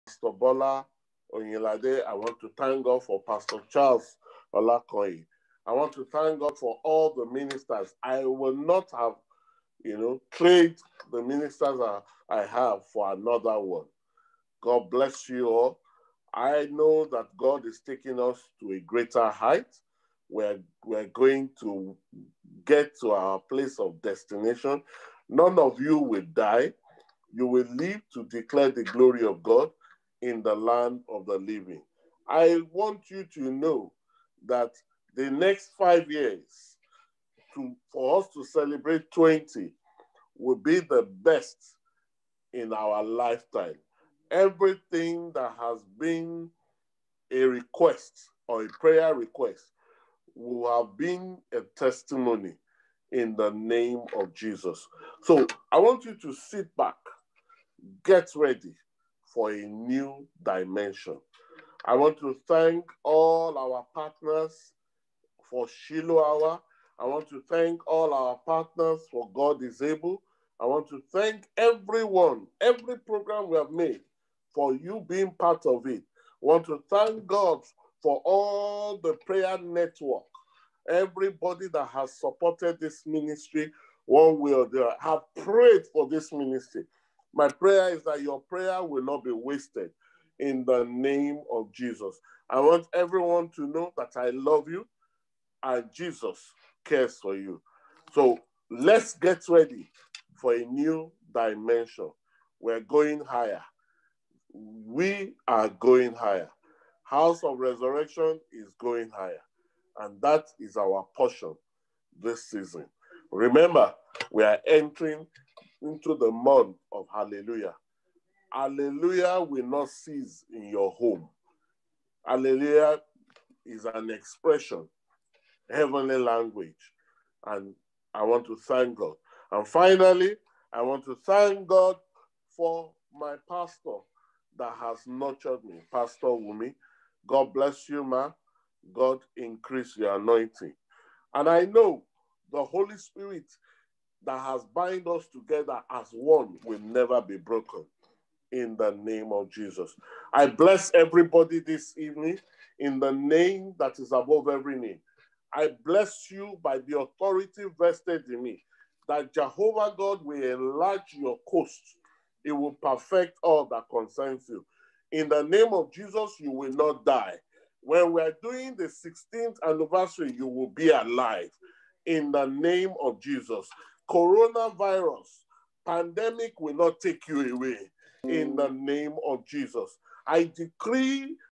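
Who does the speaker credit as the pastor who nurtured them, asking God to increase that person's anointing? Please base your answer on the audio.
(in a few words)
Pastor Wumi.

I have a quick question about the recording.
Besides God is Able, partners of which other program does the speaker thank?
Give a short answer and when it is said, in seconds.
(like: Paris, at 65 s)
Shiloh Hour, at 65 s.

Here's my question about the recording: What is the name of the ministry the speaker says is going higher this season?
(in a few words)
House of Resurrection.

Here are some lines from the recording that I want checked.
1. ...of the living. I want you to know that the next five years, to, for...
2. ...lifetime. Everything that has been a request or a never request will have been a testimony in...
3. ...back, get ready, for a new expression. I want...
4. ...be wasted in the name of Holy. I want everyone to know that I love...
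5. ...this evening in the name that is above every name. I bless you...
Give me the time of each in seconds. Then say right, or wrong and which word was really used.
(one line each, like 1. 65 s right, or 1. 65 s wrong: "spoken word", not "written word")
1. 31 s right
2. 43 s wrong: "prayer", not "never"
3. 56 s wrong: "dimension", not "expression"
4. 89 s wrong: "Jesus", not "Holy"
5. 151 s right.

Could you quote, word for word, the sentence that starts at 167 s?
When we are doing the 16th anniversary, you will be alive.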